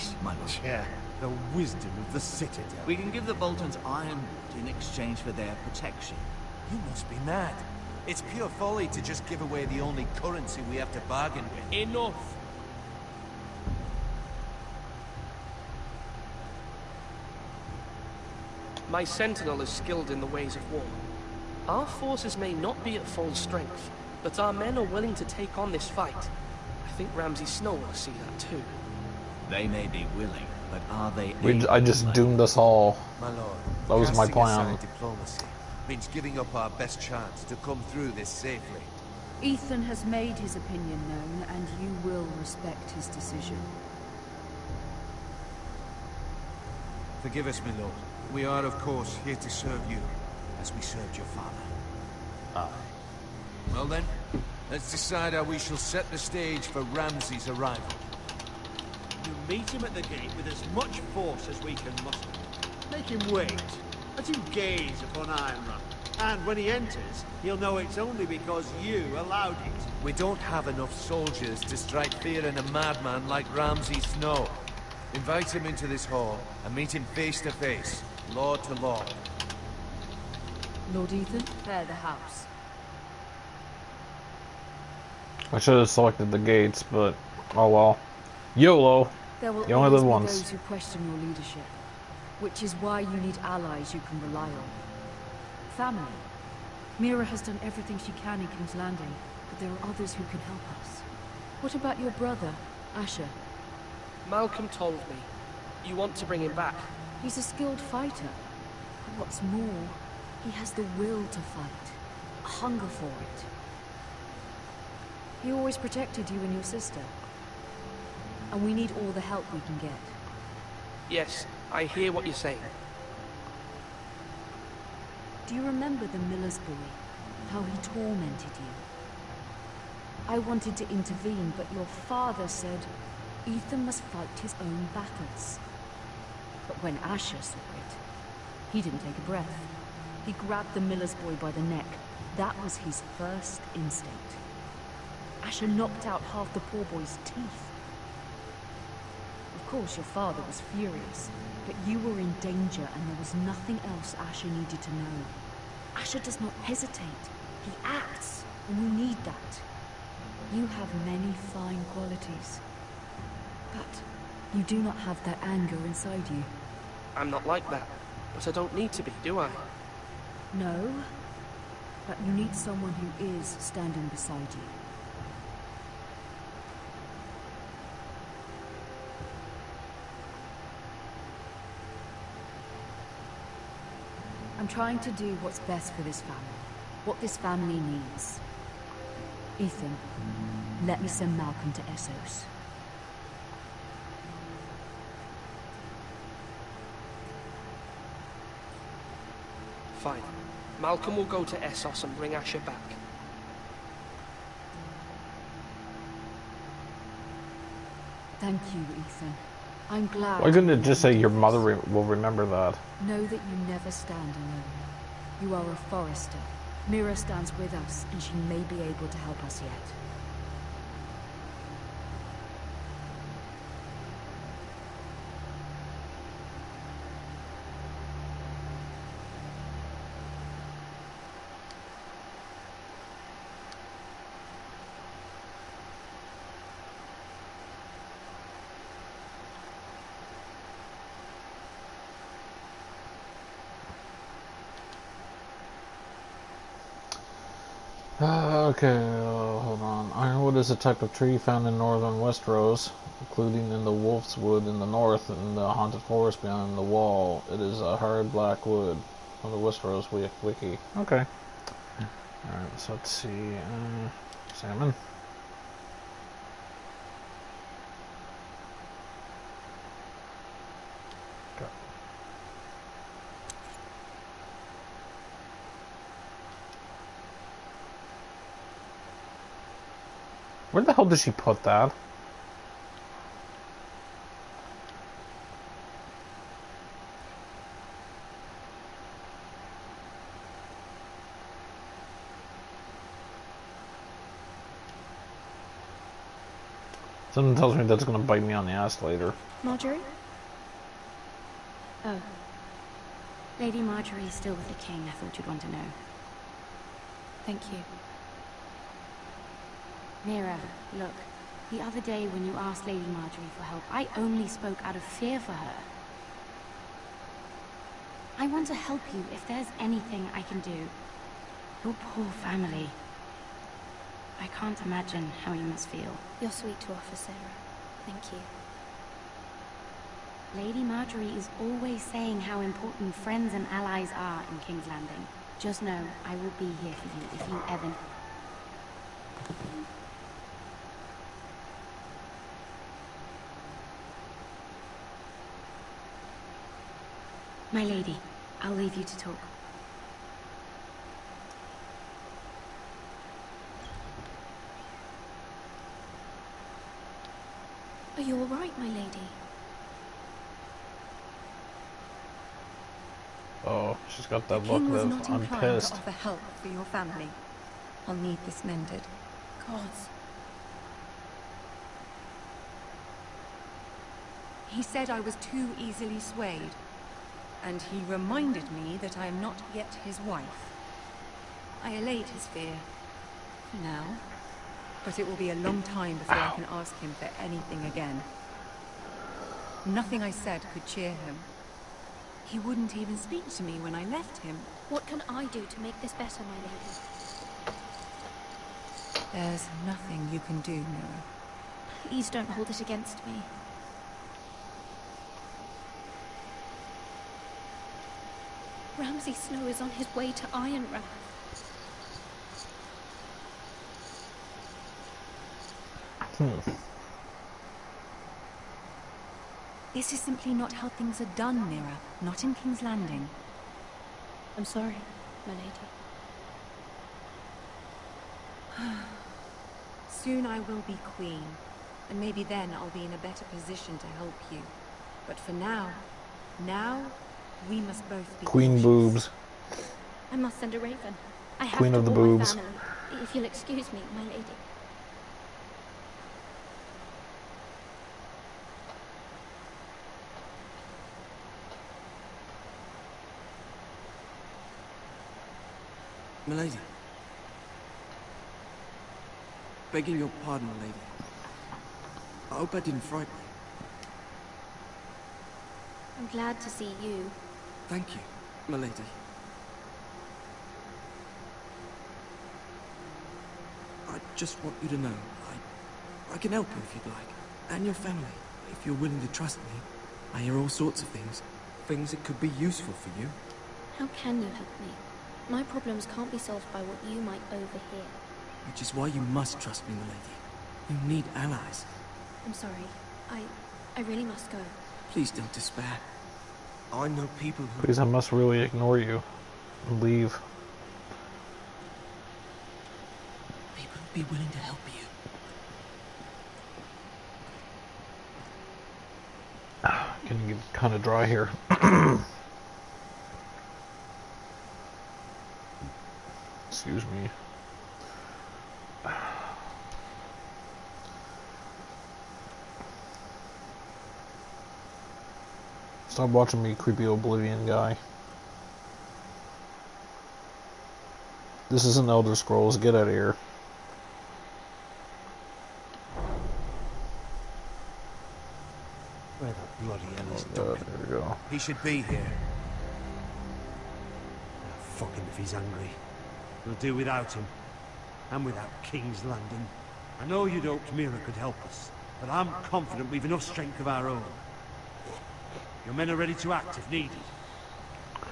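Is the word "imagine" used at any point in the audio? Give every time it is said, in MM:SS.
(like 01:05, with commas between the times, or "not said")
05:24.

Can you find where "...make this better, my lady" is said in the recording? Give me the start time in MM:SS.
06:35.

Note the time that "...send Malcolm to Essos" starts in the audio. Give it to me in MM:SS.
03:11.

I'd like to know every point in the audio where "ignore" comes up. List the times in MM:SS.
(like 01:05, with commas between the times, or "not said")
08:18.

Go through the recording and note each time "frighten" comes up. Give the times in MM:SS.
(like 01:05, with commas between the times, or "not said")
07:43.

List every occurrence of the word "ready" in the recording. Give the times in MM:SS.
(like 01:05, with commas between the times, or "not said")
09:16.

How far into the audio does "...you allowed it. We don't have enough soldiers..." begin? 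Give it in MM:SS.
01:08.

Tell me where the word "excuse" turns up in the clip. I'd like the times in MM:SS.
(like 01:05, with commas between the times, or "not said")
07:23, 08:36.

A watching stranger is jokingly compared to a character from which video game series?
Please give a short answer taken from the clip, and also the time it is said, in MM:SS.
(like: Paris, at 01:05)
Elder Scrolls, at 08:52.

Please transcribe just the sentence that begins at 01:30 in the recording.
Those who question your leadership, which is why you need allies you can rely on.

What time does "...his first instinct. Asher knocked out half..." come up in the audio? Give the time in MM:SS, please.
02:22.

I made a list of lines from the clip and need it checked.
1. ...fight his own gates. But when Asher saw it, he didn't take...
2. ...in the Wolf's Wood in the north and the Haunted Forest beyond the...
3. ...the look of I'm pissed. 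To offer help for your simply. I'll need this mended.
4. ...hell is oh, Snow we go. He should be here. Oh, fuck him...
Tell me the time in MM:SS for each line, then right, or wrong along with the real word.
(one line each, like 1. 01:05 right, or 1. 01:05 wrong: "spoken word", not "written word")
1. 02:14 wrong: "battles", not "gates"
2. 04:13 right
3. 06:04 wrong: "family", not "simply"
4. 09:00 wrong: "There", not "Snow".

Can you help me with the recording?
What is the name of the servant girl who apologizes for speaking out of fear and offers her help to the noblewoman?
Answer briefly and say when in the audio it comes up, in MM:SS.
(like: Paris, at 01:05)
Sera, at 05:27.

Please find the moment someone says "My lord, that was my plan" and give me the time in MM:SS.
00:33.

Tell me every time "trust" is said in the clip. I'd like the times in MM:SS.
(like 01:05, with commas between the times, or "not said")
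07:59, 08:09.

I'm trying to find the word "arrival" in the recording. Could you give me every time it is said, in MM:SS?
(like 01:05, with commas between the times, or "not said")
00:57.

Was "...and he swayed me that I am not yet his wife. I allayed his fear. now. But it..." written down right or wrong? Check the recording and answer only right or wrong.
wrong.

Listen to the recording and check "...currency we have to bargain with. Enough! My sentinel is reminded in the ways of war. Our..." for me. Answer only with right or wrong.
wrong.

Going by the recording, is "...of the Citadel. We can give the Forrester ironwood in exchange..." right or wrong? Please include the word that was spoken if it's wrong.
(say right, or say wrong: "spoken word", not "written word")
wrong: "Boltons", not "Forrester".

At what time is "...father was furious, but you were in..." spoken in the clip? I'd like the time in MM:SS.
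02:30.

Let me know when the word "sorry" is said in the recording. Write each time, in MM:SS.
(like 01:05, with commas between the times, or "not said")
07:04, 08:12.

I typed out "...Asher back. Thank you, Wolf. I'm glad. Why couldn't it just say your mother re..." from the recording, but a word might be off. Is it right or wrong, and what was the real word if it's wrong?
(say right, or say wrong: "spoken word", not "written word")
wrong: "Ethan", not "Wolf".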